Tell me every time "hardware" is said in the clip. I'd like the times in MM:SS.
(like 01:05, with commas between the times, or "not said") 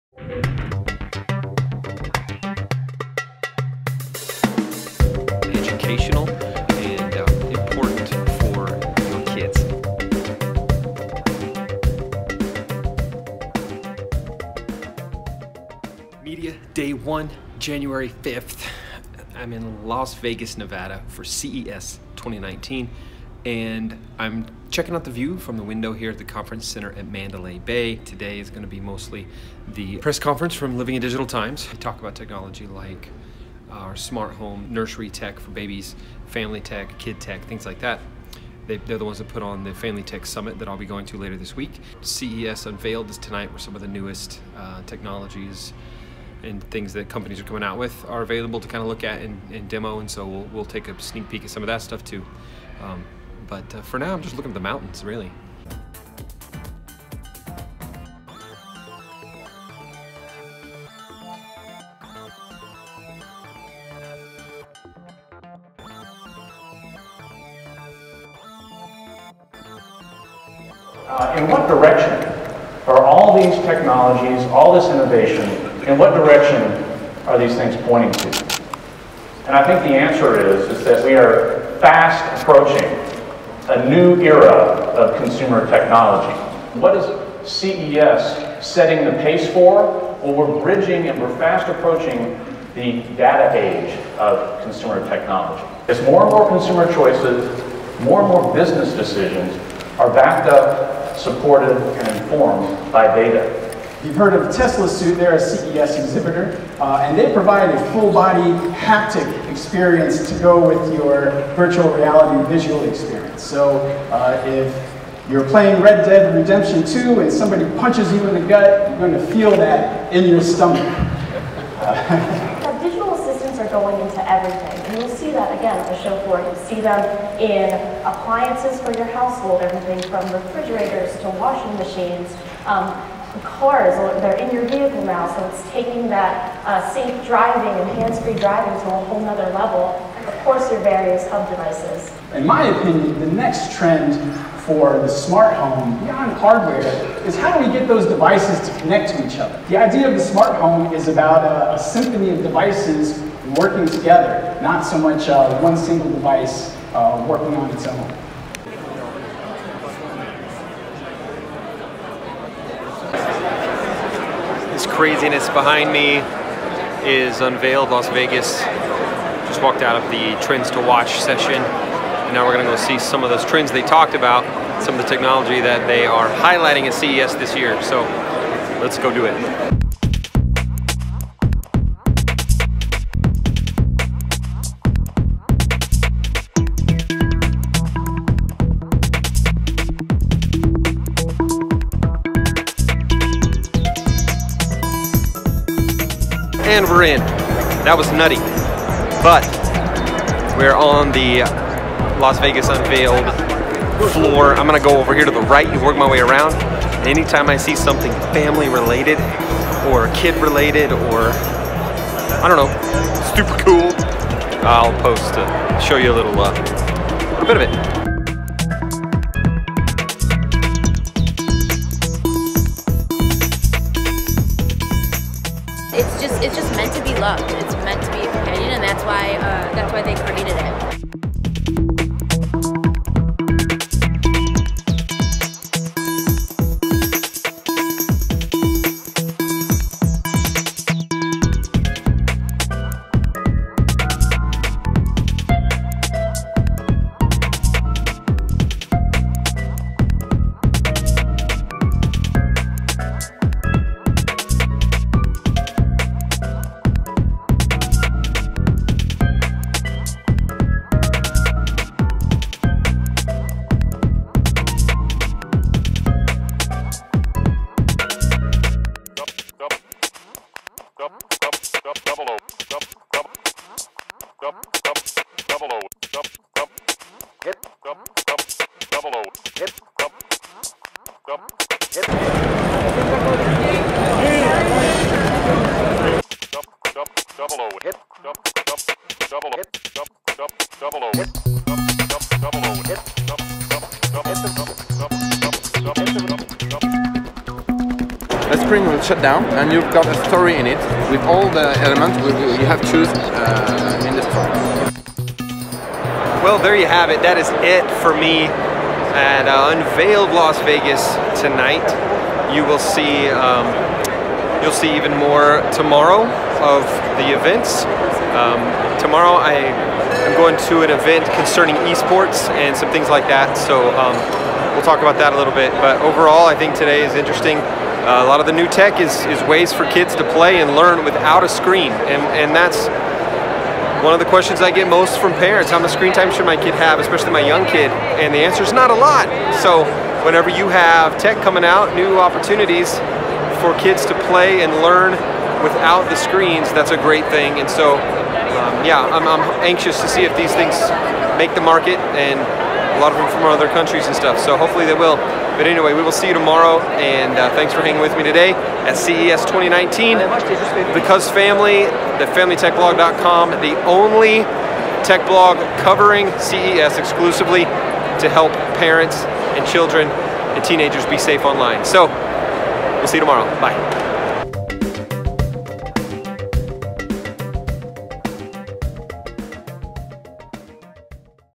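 02:26.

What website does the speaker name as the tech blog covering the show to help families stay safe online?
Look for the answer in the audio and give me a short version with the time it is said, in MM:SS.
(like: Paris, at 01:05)
FamilyTechBlog.com, at 06:02.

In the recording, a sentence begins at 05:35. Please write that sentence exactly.
How much screen time should my kid have, especially my young kid?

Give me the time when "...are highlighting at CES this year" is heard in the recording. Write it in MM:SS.
02:56.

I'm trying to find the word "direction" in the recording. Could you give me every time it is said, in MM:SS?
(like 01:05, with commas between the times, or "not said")
01:11, 01:16.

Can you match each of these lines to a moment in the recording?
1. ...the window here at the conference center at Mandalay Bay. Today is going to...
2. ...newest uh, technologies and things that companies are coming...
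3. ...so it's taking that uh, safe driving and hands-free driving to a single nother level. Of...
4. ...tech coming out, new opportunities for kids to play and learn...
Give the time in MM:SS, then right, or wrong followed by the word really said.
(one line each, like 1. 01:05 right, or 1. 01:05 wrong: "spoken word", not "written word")
1. 00:25 right
2. 00:43 right
3. 02:15 wrong: "whole", not "single"
4. 05:41 right.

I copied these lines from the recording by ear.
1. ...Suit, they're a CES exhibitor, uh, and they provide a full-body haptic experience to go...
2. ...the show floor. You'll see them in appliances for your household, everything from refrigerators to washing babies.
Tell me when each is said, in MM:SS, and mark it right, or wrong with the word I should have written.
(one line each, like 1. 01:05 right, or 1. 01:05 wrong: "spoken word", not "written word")
1. 01:44 right
2. 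02:05 wrong: "machines", not "babies".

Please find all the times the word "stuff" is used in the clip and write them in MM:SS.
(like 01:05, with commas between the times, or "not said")
00:51, 05:54.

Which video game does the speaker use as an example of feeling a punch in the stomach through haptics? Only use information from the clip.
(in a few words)
Red Dead Redemption 2.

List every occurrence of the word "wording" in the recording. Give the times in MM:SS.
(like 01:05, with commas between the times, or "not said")
not said.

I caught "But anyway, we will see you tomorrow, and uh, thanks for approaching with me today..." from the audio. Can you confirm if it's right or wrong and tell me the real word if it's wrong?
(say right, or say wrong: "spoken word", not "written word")
wrong: "hanging", not "approaching".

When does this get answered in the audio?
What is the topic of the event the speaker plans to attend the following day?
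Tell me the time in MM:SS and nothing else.
05:21.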